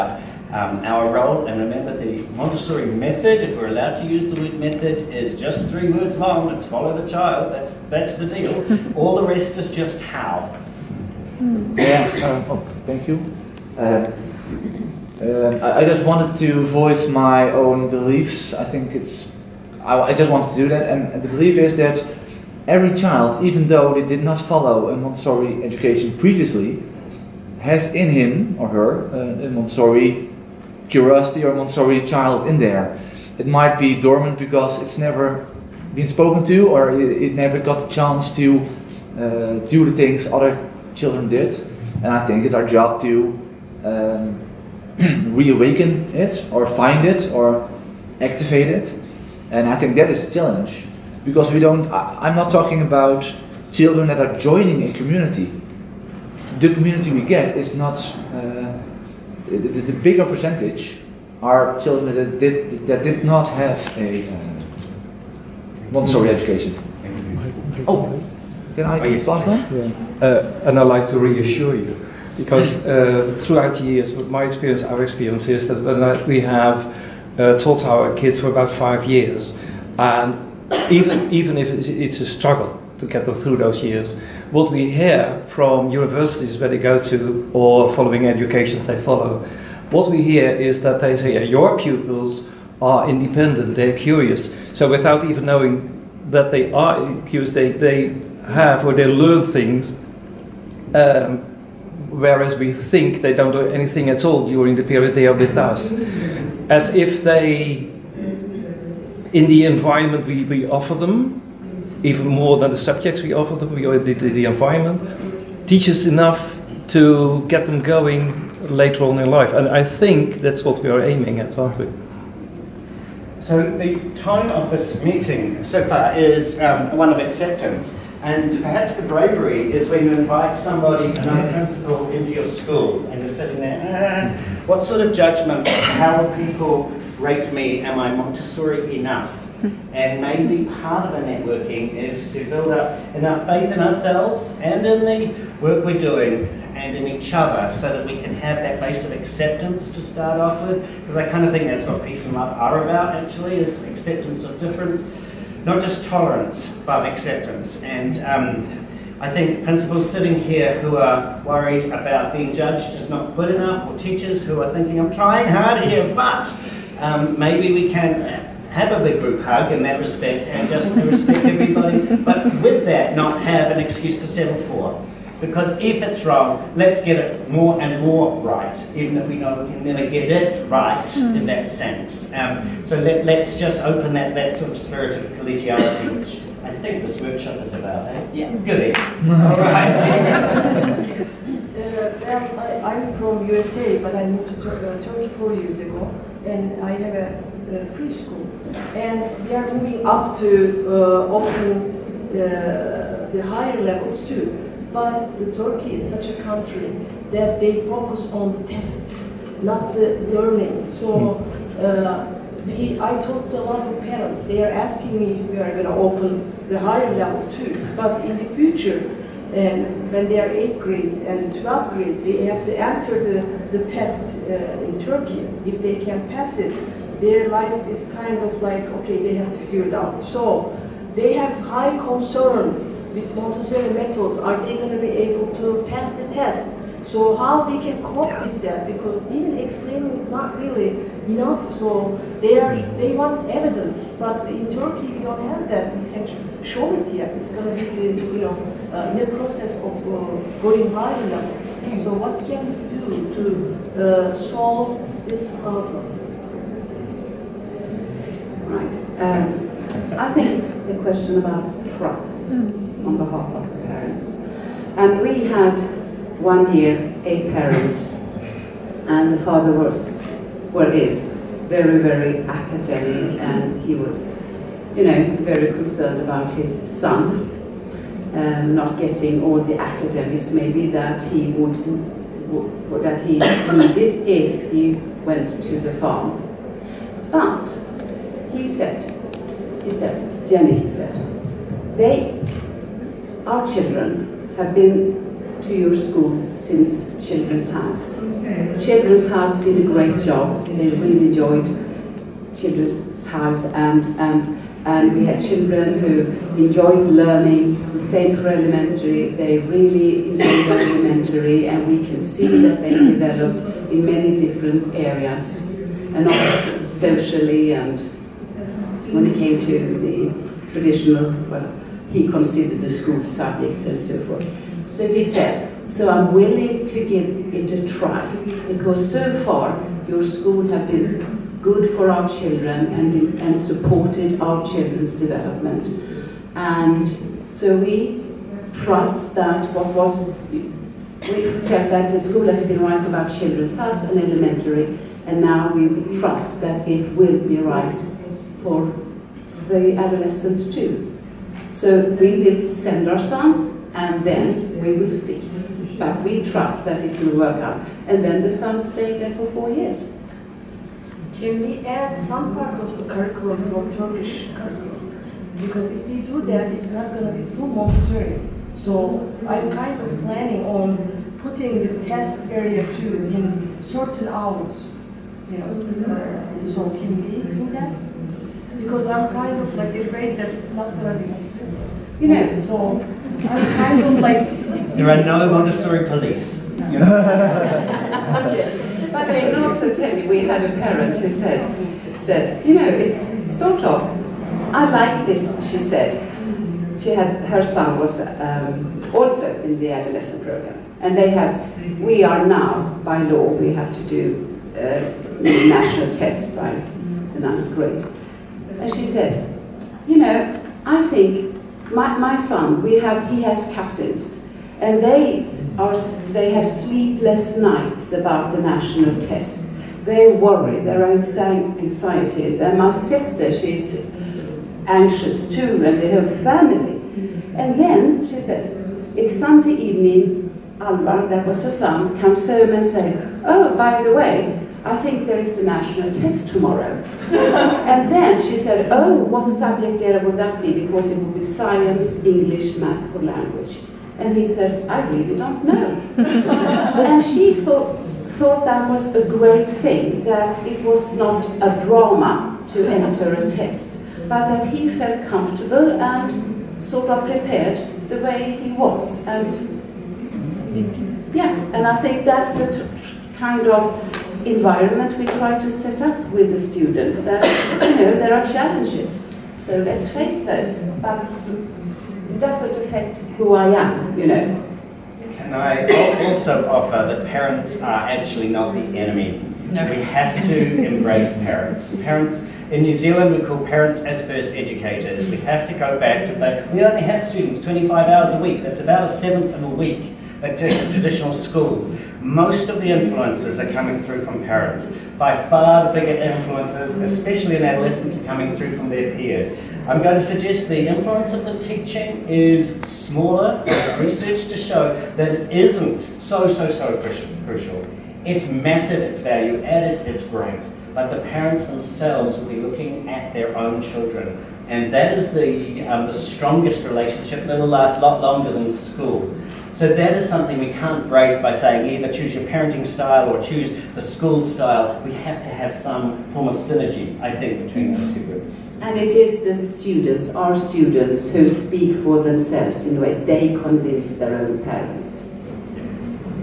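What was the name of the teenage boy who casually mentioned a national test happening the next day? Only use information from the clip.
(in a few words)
Alvar.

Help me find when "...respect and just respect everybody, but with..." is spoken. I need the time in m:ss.
2:49.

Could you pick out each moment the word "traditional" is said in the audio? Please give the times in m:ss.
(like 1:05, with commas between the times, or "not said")
5:20, 8:10.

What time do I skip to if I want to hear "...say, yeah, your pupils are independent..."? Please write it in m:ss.
1:31.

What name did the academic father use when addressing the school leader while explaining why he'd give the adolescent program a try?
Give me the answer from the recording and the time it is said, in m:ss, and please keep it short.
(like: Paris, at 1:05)
Jenny, at 4:50.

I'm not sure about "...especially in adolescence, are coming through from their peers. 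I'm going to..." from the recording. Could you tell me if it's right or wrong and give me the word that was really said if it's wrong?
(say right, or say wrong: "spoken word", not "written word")
right.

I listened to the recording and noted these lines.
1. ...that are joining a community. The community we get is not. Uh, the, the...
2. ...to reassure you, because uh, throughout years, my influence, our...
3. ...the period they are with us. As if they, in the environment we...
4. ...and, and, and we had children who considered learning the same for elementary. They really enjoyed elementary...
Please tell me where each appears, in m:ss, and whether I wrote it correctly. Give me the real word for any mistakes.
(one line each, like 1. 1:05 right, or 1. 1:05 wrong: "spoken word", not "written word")
1. 0:54 right
2. 1:11 wrong: "experience", not "influence"
3. 1:44 right
4. 5:03 wrong: "enjoyed", not "considered".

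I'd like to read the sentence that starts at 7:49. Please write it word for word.
So let's face those, but it doesn't affect who I am, you know.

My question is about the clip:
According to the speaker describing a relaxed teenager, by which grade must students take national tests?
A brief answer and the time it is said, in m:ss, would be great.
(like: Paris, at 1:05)
ninth grade, at 6:47.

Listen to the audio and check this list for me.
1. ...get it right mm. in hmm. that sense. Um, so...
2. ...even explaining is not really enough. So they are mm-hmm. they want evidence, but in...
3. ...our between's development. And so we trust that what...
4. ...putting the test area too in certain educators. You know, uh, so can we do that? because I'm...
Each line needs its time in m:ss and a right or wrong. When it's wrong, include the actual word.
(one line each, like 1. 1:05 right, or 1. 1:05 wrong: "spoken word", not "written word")
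1. 3:00 right
2. 3:59 right
3. 5:34 wrong: "children", not "between"
4. 6:11 wrong: "hours", not "educators".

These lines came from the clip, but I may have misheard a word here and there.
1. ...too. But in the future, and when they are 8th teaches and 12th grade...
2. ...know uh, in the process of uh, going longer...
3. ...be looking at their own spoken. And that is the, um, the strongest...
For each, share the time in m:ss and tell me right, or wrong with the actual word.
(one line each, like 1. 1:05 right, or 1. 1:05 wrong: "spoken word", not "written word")
1. 3:37 wrong: "grades", not "teaches"
2. 4:08 wrong: "higher", not "longer"
3. 8:32 wrong: "children", not "spoken".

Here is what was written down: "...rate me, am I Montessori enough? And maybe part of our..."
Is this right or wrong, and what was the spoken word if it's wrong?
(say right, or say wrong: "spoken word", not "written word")
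right.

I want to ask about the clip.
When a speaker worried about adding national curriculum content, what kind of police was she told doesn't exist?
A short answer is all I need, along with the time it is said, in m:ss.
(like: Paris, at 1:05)
Montessori police, at 6:25.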